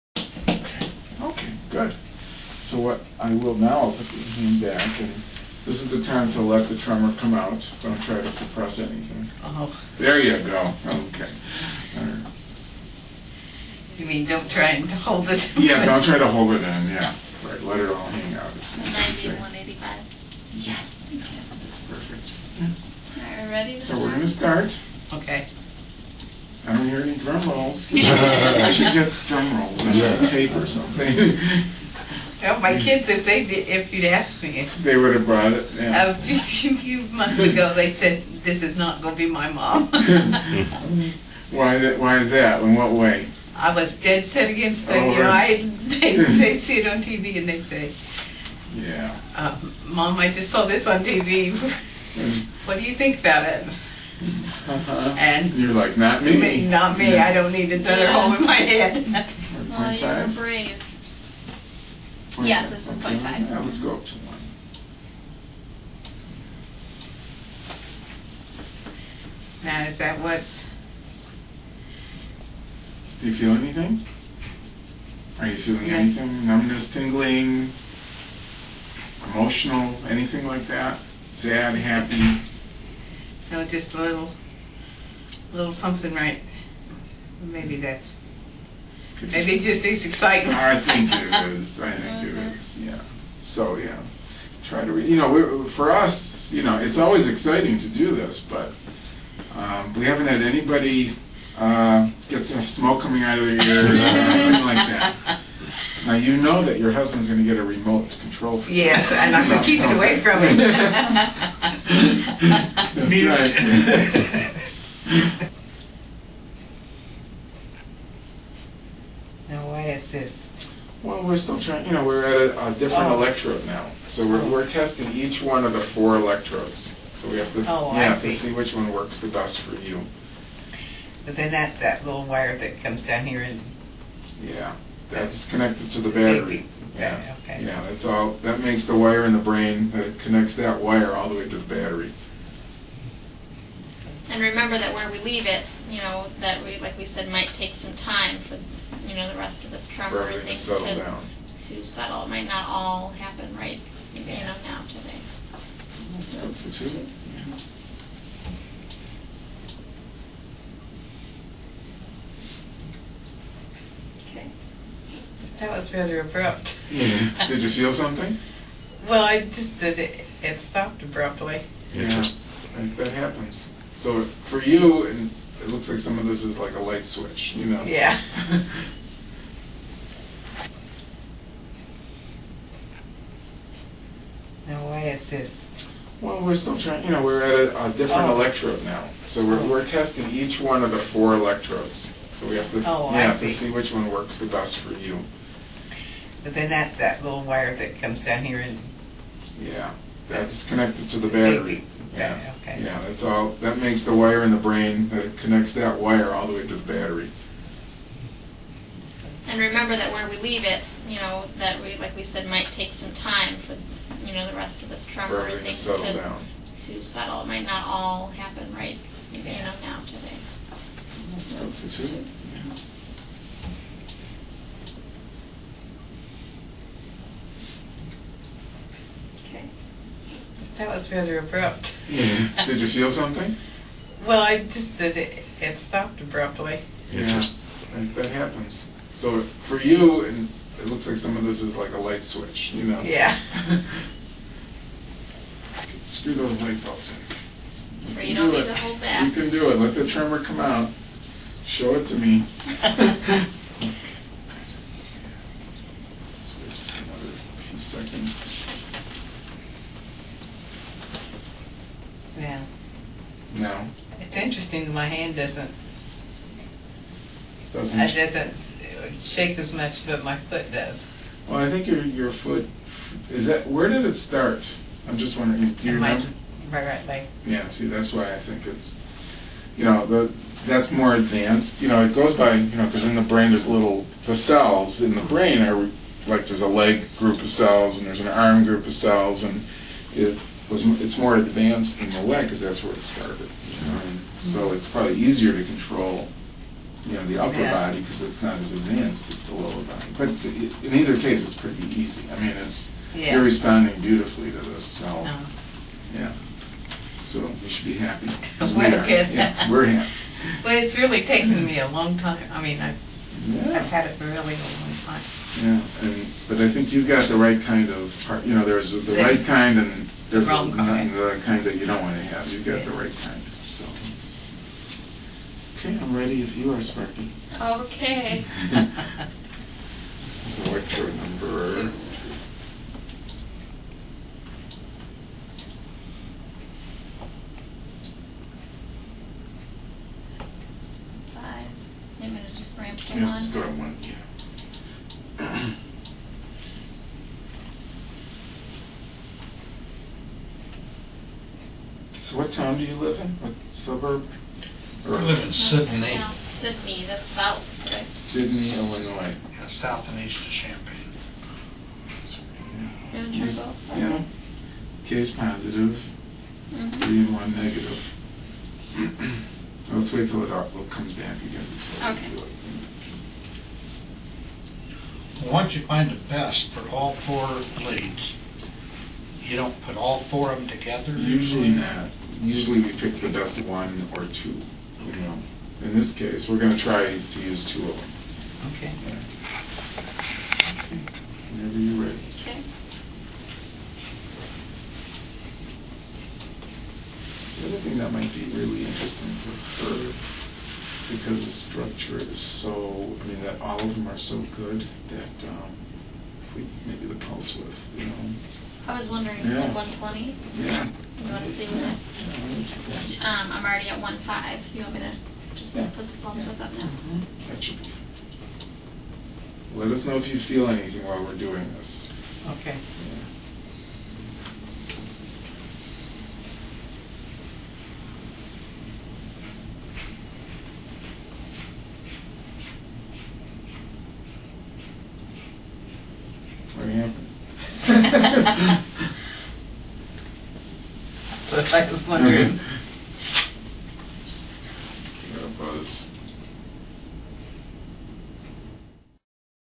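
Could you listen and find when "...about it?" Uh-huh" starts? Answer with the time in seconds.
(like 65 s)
53 s.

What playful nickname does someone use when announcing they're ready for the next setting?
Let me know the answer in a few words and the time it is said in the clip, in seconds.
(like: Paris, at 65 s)
Sparky, at 326 s.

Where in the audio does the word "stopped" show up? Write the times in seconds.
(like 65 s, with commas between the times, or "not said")
170 s, 235 s.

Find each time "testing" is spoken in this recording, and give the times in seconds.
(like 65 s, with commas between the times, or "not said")
124 s, 189 s.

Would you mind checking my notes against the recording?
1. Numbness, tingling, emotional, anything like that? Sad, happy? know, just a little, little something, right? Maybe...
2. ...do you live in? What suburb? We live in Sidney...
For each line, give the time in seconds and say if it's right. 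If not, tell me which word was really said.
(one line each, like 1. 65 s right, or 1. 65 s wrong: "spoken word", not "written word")
1. 76 s right
2. 352 s right.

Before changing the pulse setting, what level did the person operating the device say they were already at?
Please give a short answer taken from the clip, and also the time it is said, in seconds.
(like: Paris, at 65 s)
1.5, at 414 s.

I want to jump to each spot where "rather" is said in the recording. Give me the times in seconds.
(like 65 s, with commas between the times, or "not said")
165 s, 231 s.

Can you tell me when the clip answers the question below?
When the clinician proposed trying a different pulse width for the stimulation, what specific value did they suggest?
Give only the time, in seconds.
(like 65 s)
409 s.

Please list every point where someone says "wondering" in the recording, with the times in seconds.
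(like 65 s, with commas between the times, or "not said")
275 s, 409 s, 442 s.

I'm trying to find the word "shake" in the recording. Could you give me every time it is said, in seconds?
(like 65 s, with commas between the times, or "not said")
269 s.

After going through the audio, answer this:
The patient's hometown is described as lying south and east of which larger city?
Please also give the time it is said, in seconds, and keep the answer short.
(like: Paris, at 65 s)
Champaign, at 360 s.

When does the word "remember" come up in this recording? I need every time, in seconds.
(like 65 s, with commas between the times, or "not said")
144 s, 209 s, 276 s.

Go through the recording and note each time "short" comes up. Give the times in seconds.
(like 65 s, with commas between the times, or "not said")
not said.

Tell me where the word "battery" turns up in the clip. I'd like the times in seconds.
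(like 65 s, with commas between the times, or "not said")
136 s, 141 s, 201 s, 206 s.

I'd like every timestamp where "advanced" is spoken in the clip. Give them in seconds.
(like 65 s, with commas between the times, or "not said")
281 s, 291 s, 298 s.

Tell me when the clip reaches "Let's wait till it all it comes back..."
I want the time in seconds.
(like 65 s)
369 s.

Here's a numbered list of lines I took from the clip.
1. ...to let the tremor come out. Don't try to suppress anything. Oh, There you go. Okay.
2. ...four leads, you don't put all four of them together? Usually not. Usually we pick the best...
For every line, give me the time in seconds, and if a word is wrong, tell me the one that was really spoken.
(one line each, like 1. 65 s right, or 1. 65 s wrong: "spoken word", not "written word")
1. 6 s right
2. 377 s right.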